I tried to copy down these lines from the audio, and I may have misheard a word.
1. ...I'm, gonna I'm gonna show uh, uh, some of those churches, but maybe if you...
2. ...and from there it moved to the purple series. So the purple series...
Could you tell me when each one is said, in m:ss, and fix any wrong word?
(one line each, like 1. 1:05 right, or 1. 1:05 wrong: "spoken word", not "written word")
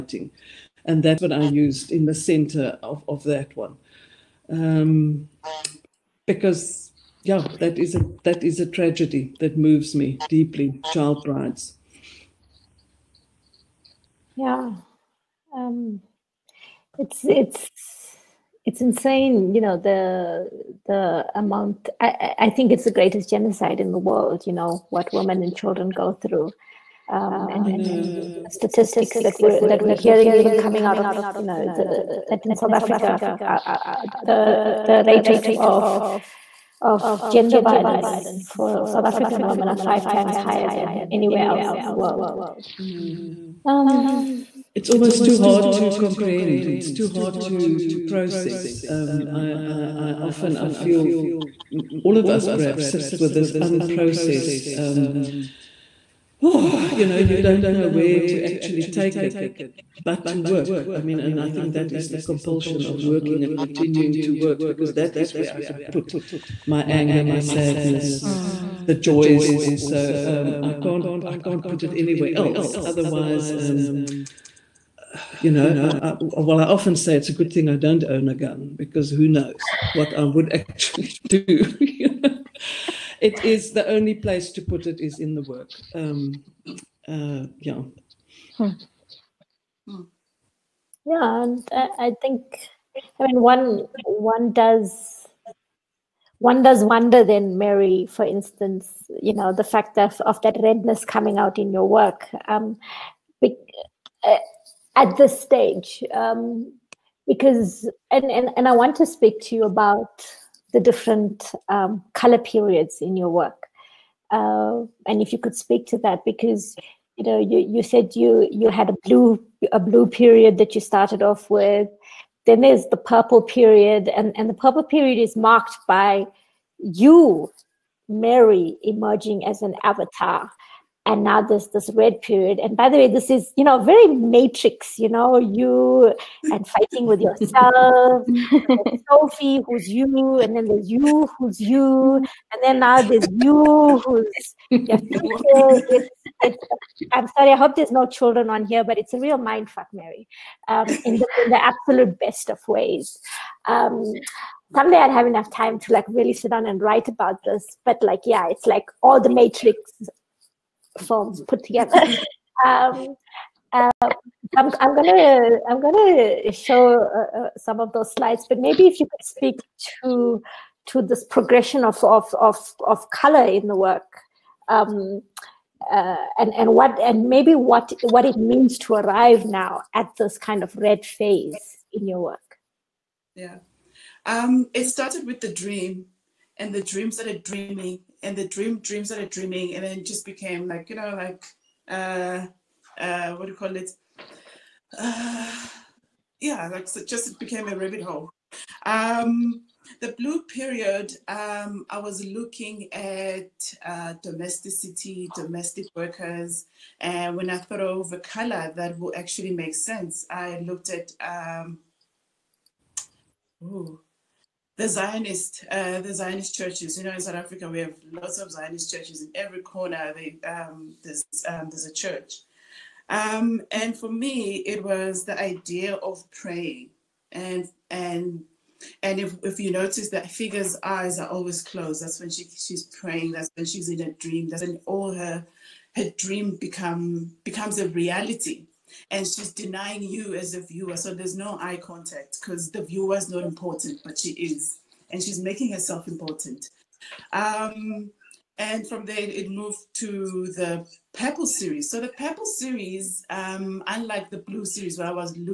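1. 2:44 wrong: "slides", not "churches"
2. 4:08 right.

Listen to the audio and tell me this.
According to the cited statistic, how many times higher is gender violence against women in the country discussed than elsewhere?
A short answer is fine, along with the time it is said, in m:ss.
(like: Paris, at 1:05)
5, at 0:39.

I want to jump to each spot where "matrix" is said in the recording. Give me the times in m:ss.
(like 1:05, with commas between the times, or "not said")
2:14, 2:39.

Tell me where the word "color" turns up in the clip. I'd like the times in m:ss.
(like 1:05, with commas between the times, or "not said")
1:52, 2:53, 3:28.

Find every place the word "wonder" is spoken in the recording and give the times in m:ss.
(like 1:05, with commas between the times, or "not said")
1:36.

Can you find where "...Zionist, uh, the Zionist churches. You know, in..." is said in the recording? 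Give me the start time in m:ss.
3:34.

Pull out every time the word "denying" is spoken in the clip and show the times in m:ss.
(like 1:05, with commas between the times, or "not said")
3:59.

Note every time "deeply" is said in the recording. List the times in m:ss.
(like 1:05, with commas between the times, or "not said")
0:10.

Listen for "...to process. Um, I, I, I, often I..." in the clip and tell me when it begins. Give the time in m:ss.
0:47.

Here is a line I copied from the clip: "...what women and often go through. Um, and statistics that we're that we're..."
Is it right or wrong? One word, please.
wrong.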